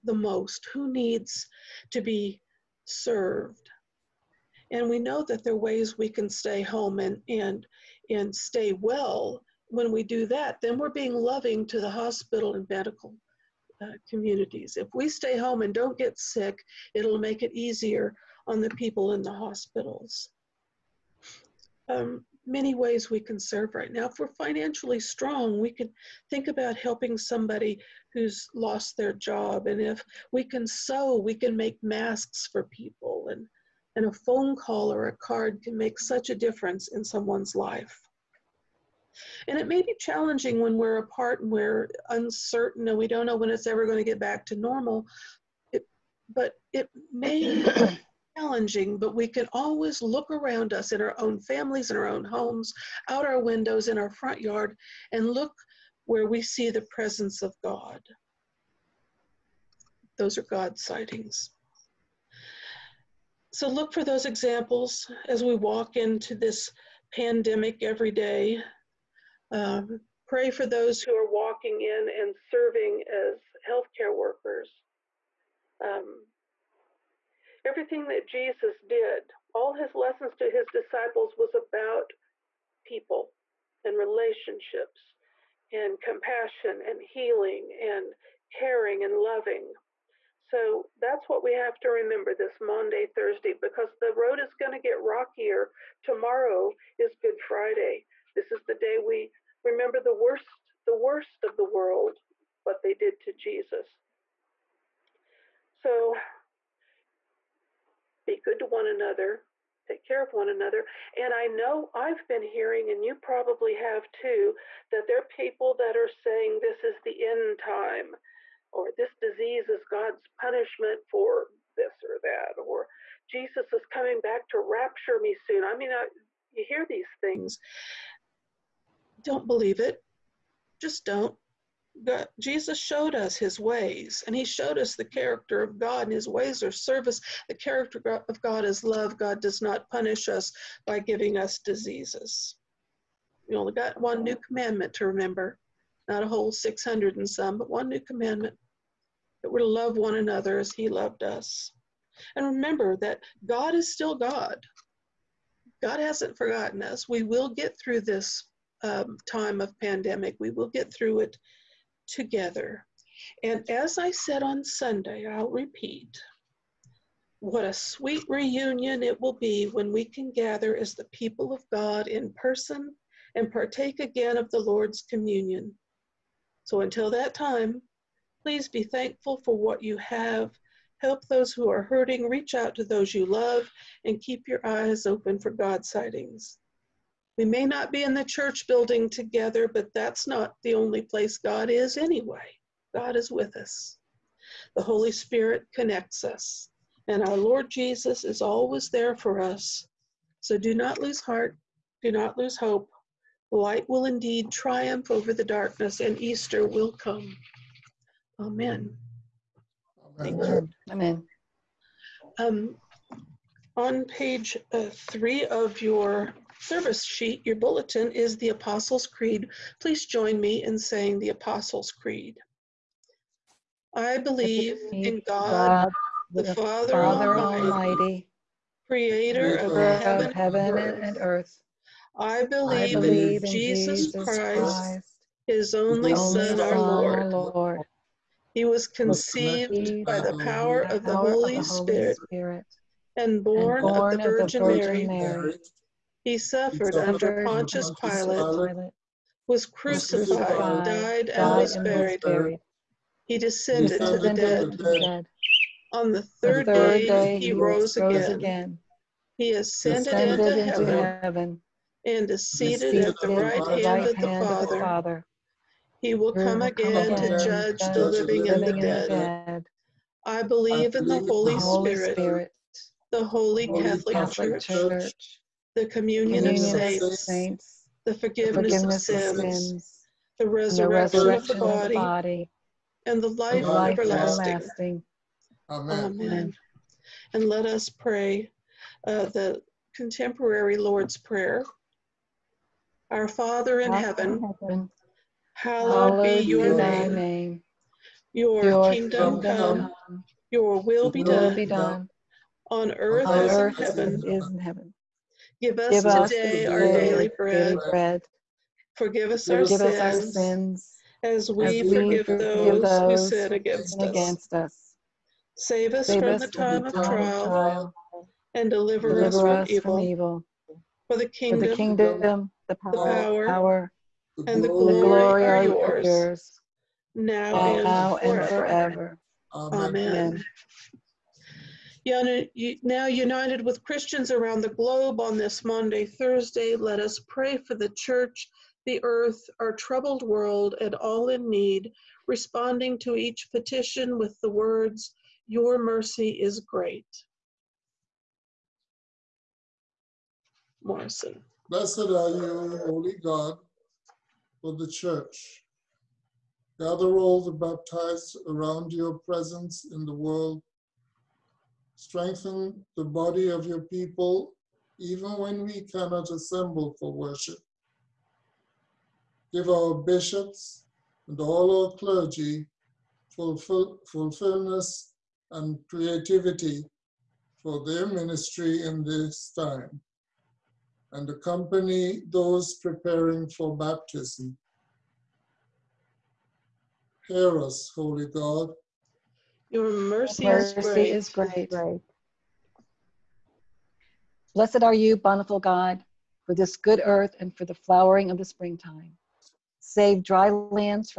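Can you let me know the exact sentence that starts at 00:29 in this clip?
And if we can sew, we can make masks for people.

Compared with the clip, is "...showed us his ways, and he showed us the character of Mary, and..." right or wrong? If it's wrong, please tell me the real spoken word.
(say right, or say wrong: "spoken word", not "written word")
wrong: "God", not "Mary".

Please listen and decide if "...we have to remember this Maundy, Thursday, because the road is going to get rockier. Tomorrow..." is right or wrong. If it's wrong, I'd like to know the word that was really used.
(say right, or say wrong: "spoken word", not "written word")
right.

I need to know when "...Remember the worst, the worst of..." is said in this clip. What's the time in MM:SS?
01:39.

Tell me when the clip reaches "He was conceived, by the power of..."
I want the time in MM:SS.
03:58.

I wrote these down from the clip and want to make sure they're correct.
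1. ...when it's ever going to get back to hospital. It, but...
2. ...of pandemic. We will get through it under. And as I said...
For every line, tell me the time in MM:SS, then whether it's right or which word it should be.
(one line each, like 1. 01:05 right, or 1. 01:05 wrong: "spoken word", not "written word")
1. 00:43 wrong: "normal", not "hospital"
2. 02:39 wrong: "together", not "under".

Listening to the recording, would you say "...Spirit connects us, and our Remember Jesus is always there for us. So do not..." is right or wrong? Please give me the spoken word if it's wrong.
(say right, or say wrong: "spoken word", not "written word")
wrong: "Lord", not "Remember".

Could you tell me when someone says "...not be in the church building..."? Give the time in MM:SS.
03:07.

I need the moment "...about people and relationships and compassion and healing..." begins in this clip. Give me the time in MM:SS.
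01:21.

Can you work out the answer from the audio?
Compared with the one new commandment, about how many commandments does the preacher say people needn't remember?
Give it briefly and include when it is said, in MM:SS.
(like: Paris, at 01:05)
600 and some, at 02:26.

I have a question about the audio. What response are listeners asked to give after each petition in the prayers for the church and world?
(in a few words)
Your mercy is great.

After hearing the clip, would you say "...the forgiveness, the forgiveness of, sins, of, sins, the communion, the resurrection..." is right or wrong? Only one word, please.
wrong.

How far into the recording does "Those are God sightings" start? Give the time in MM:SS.
01:00.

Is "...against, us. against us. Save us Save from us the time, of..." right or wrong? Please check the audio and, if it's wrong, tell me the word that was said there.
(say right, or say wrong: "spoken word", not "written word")
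right.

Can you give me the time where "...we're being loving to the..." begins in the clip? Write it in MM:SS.
00:10.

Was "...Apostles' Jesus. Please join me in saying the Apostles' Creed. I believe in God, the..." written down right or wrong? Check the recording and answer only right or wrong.
wrong.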